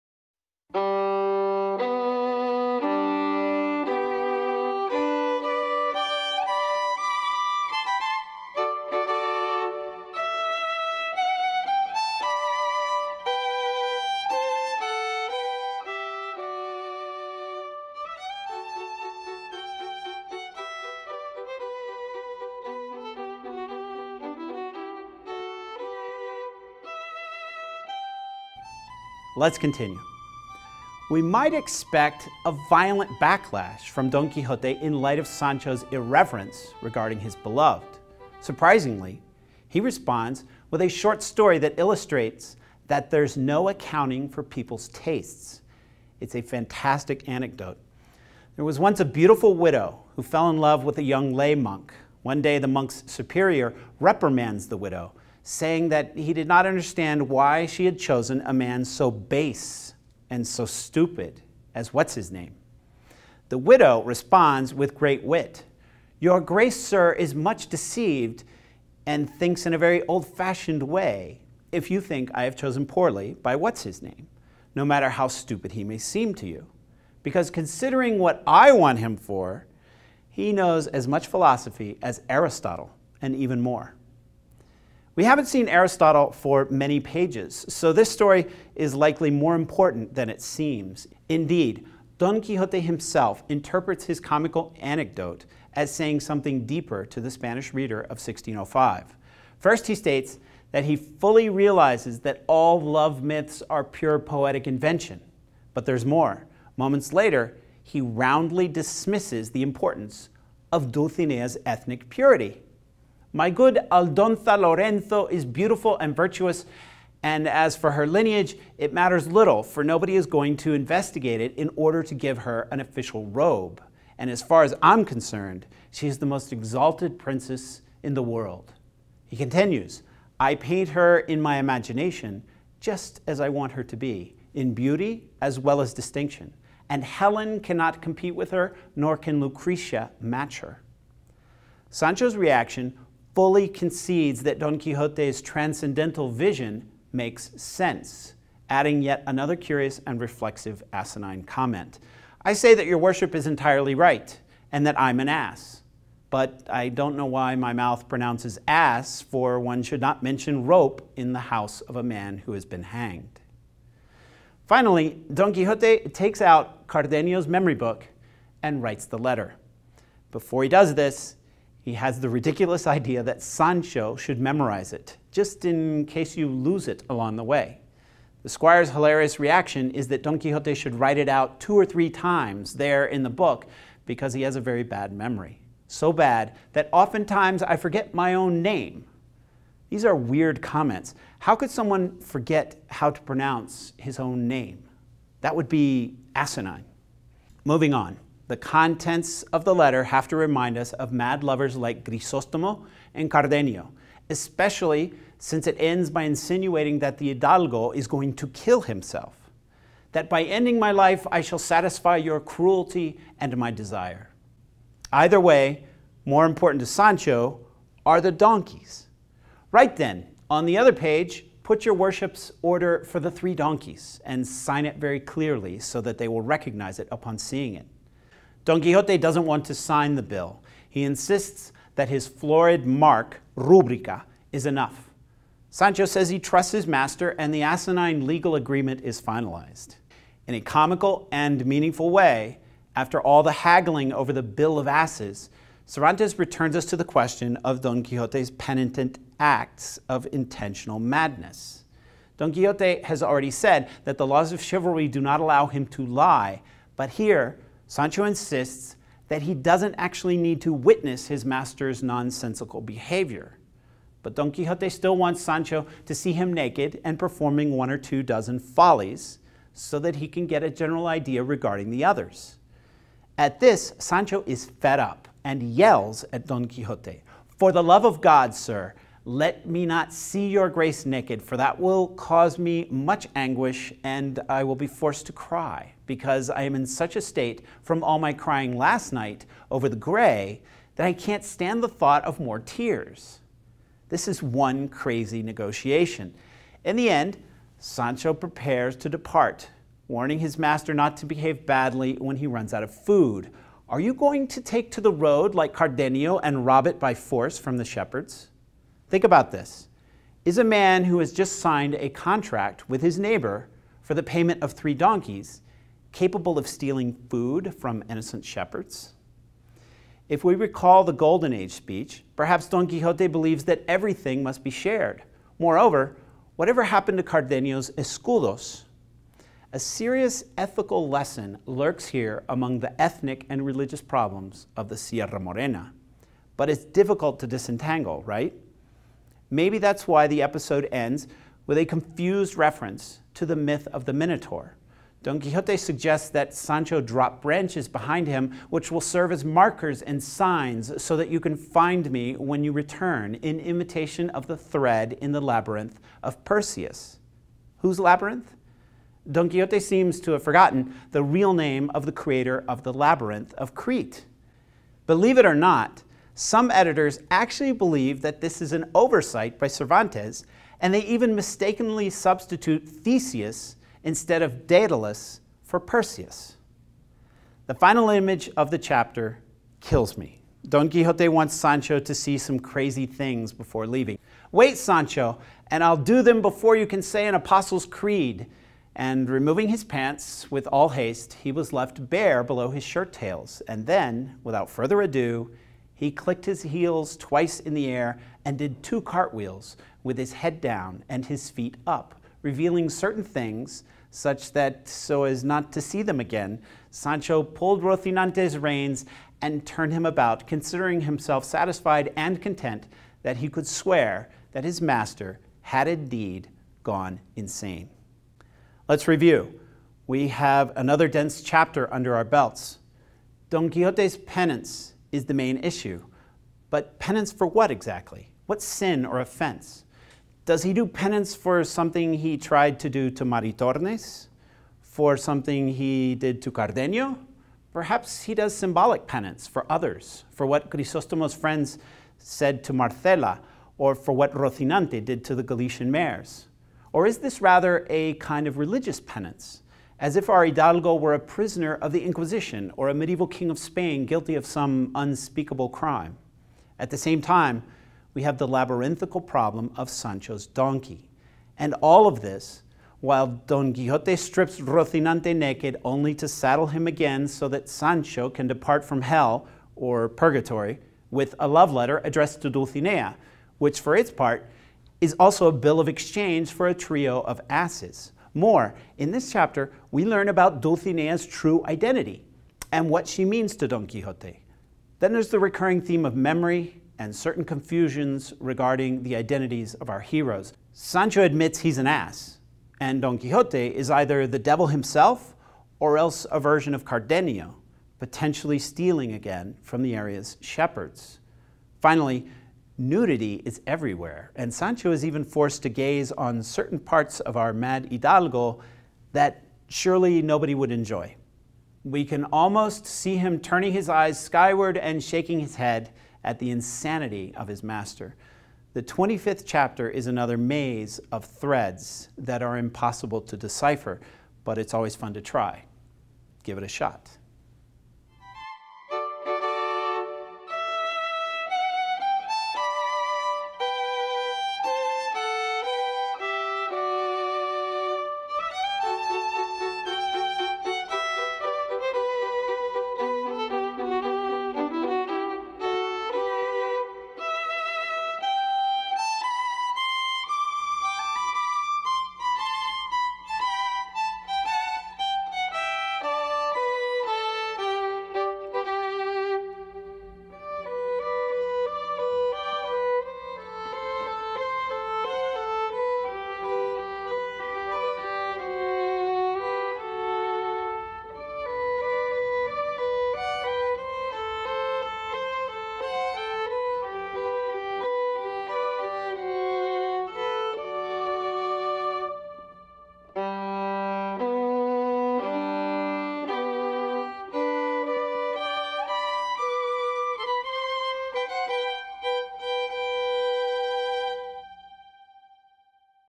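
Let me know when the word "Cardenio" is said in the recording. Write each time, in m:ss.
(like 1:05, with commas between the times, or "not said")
2:46, 3:23, 5:05, 5:27, 7:16, 8:16.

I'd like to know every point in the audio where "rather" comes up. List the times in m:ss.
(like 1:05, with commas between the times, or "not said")
7:27.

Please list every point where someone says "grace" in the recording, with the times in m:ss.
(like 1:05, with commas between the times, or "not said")
1:06, 4:40.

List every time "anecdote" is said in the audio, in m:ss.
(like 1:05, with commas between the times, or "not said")
0:47, 1:34.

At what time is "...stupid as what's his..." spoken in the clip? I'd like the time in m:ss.
1:00.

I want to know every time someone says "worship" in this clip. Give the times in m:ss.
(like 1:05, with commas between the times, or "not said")
2:32, 3:41.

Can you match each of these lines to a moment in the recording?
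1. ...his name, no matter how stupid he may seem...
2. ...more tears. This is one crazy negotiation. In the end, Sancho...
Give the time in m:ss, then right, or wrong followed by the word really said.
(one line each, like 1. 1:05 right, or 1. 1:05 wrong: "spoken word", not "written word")
1. 1:13 right
2. 4:52 right.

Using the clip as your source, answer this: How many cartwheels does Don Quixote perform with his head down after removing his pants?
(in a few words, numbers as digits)
2.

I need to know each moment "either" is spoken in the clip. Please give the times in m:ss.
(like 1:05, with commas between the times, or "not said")
3:35, 8:13.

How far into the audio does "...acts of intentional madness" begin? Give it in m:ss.
4:09.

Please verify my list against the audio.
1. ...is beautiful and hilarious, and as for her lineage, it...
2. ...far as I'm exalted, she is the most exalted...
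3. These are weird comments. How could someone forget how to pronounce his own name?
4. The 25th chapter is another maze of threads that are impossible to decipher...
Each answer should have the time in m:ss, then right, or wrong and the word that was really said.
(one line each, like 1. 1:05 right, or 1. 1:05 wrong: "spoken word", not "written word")
1. 1:55 wrong: "virtuous", not "hilarious"
2. 2:04 wrong: "concerned", not "exalted"
3. 3:09 right
4. 8:38 right.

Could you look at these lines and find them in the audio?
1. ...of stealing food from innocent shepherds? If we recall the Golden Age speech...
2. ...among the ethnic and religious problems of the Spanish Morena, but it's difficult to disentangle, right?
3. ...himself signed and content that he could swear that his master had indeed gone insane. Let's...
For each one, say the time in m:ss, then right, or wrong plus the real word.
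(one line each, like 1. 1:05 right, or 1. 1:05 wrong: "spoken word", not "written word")
1. 5:16 right
2. 5:32 wrong: "Sierra", not "Spanish"
3. 6:51 wrong: "satisfied", not "signed".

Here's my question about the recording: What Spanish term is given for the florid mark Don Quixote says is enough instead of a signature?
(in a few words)
rubrica.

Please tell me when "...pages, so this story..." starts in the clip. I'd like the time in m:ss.
1:26.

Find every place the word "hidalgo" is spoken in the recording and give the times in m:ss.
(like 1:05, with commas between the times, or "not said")
3:27, 7:30, 8:27.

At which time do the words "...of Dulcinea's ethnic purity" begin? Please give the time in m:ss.
1:50.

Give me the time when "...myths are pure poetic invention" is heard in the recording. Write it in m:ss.
1:43.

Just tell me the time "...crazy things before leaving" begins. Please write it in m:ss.
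6:22.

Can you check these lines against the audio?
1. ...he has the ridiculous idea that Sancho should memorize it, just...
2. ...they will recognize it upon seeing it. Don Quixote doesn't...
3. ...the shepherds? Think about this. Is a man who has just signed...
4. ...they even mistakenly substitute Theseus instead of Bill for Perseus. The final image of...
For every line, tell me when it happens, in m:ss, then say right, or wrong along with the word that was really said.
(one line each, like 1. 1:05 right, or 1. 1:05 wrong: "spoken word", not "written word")
1. 2:51 right
2. 3:46 right
3. 5:07 right
4. 6:10 wrong: "Daedalus", not "Bill".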